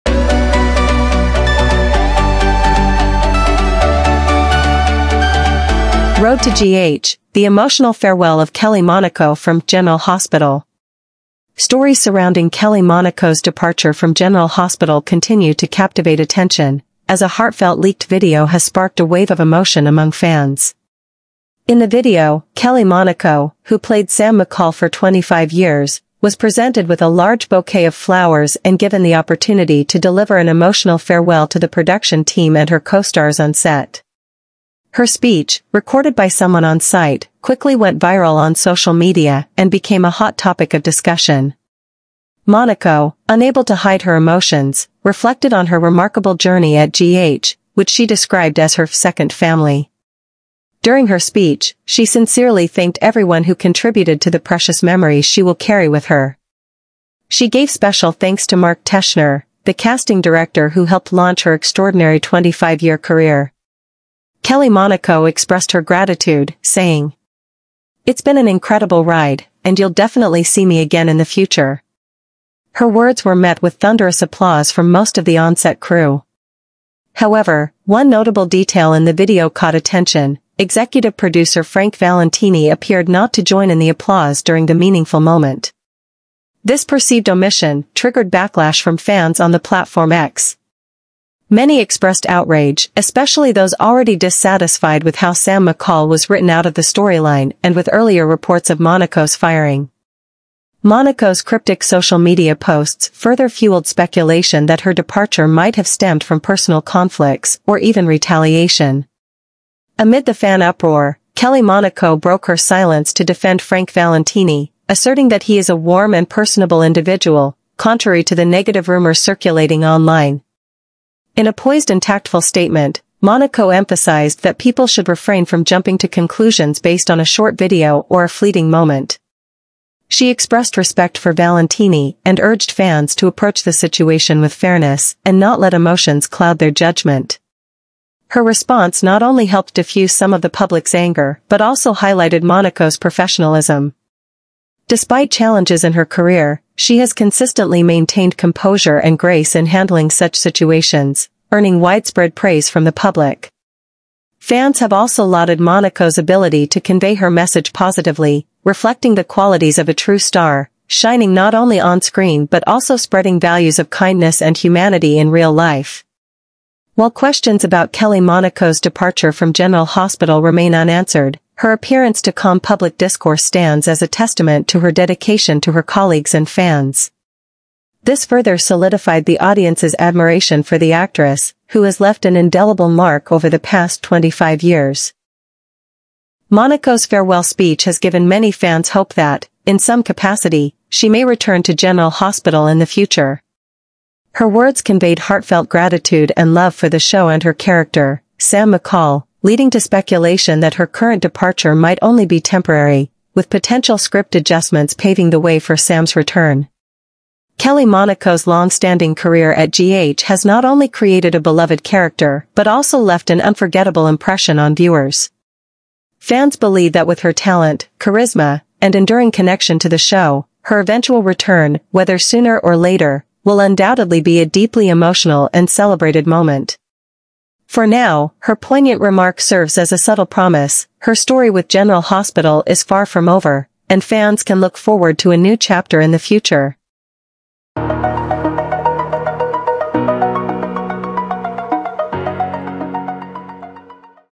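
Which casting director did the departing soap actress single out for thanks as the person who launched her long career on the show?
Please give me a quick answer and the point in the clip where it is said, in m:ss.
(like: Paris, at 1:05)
Mark Teschner, at 0:58.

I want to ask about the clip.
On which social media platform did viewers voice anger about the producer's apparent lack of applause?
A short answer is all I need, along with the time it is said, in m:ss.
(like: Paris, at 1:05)
X, at 1:30.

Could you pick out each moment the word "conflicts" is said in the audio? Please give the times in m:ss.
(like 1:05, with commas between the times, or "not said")
1:46.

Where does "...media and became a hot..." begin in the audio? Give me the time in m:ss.
0:38.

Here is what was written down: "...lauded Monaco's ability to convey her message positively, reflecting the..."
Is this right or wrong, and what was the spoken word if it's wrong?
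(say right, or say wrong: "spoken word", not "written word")
right.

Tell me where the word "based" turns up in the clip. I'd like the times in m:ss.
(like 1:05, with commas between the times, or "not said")
2:06.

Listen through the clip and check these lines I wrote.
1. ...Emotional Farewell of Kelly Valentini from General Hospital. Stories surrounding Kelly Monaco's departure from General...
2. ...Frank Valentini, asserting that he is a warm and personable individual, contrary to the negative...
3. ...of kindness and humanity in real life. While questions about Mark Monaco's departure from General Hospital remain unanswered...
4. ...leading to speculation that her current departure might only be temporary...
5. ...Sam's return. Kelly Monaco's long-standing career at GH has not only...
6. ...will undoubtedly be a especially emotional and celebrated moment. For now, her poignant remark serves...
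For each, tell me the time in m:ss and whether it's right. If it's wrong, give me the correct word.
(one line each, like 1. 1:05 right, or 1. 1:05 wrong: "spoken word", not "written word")
1. 0:07 wrong: "Monaco", not "Valentini"
2. 1:53 right
3. 2:43 wrong: "Kelly", not "Mark"
4. 3:19 right
5. 3:25 right
6. 3:43 wrong: "deeply", not "especially".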